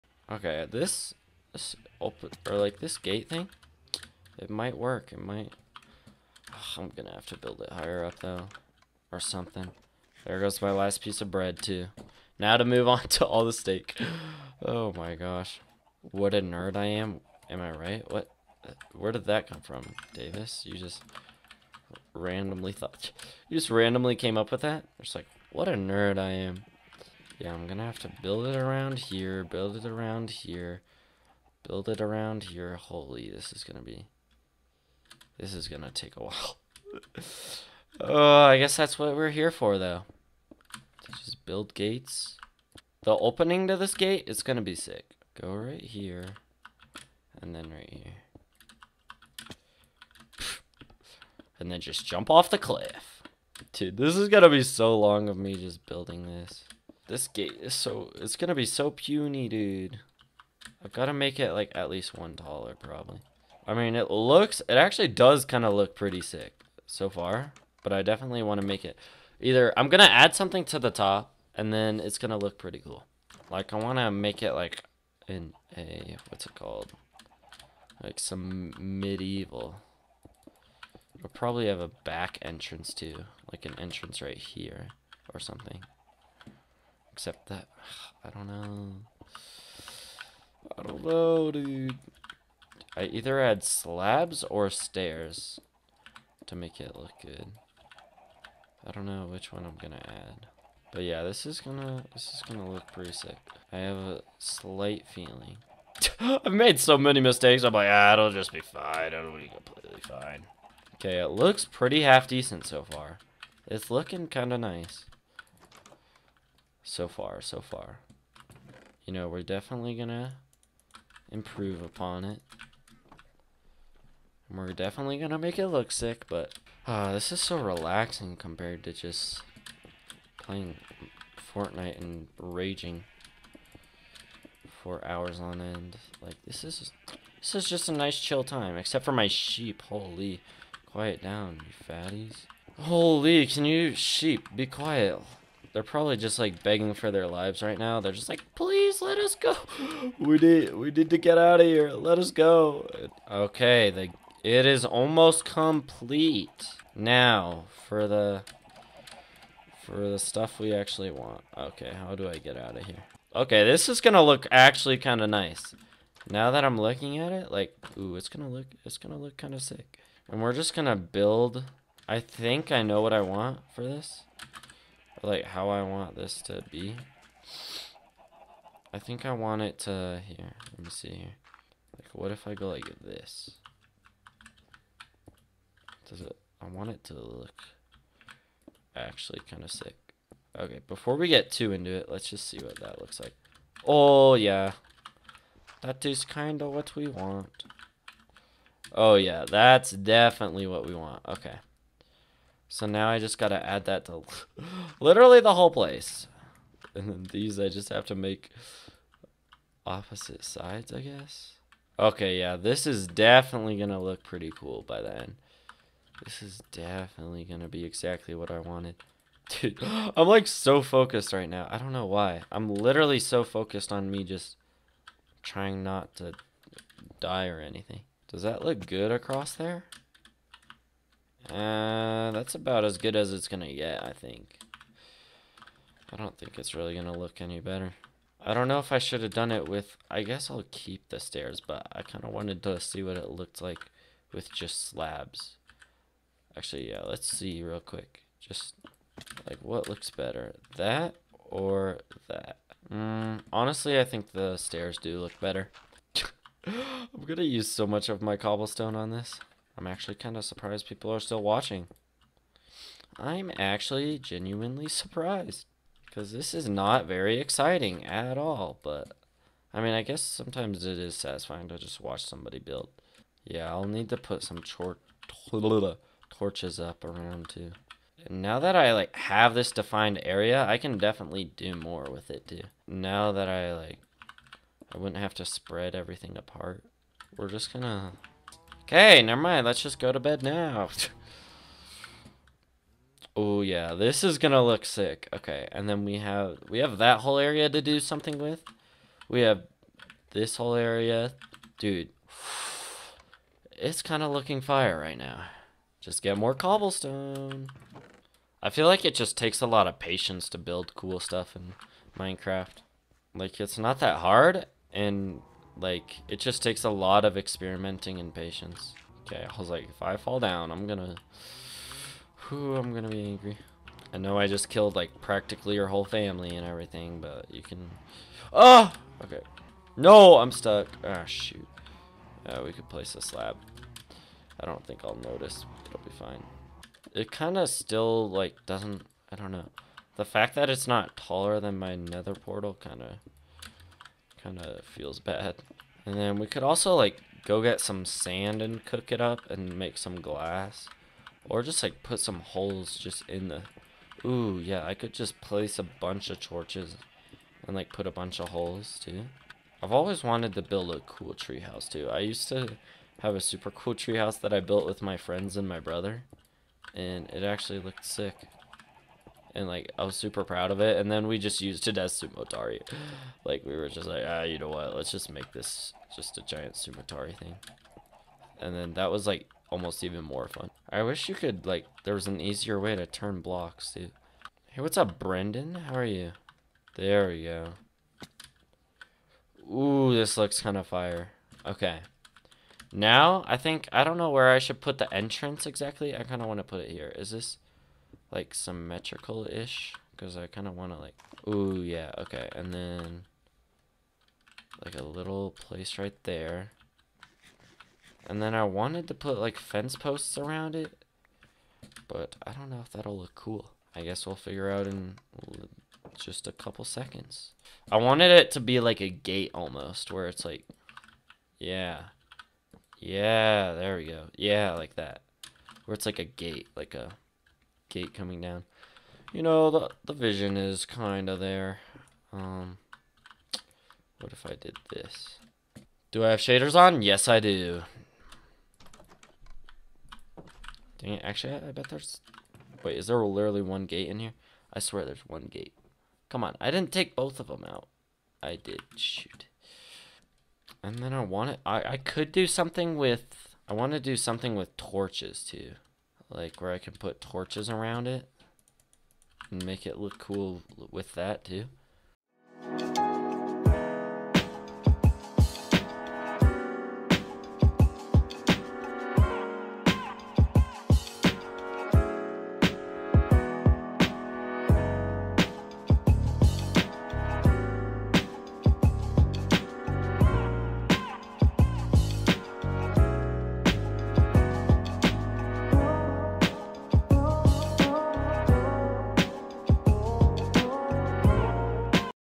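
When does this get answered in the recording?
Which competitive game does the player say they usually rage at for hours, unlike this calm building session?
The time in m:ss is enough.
2:11.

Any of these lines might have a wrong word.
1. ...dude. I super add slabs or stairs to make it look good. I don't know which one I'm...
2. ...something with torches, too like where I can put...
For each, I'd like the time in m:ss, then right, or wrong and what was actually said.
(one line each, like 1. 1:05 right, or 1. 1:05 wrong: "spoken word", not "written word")
1. 1:31 wrong: "either", not "super"
2. 7:34 right.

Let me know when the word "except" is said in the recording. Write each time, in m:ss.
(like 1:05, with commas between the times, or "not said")
1:27, 2:18.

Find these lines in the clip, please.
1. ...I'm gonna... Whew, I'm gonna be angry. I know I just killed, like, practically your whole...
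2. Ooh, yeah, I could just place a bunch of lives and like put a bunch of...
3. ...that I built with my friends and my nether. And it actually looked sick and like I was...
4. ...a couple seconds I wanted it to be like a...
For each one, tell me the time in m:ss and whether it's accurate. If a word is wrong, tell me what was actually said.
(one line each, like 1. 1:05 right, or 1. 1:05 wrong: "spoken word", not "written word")
1. 5:20 right
2. 5:54 wrong: "torches", not "lives"
3. 6:04 wrong: "brother", not "nether"
4. 6:56 right.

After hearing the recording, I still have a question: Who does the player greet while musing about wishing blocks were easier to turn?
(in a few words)
Brendan.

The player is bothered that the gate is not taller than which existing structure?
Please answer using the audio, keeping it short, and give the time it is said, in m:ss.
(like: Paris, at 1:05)
nether portal, at 5:41.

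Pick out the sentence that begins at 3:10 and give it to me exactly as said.
Okay, before we get too into it, let's just see what that looks like.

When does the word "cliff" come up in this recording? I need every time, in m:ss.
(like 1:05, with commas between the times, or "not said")
0:52.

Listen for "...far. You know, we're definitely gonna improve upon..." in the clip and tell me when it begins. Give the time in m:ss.
1:57.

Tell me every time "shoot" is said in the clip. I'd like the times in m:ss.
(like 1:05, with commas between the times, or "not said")
5:31, 7:28.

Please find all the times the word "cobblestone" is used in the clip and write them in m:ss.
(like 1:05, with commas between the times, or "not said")
4:18, 5:06.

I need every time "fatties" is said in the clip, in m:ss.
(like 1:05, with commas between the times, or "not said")
2:21.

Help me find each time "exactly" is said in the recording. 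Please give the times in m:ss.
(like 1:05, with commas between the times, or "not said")
3:37, 6:35.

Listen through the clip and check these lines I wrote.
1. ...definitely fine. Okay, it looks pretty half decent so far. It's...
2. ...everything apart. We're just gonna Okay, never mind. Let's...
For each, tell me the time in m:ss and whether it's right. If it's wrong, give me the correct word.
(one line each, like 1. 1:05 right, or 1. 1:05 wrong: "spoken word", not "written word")
1. 1:49 wrong: "completely", not "definitely"
2. 4:45 right.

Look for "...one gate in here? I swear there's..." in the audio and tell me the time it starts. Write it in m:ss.
7:23.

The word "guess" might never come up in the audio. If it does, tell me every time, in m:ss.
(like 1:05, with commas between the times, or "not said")
0:38, 3:31, 4:00, 4:30, 6:54.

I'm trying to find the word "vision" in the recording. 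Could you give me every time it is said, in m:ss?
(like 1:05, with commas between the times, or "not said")
7:10.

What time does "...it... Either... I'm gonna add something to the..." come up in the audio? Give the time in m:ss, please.
1:08.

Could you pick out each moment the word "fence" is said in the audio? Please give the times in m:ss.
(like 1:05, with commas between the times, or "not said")
6:49.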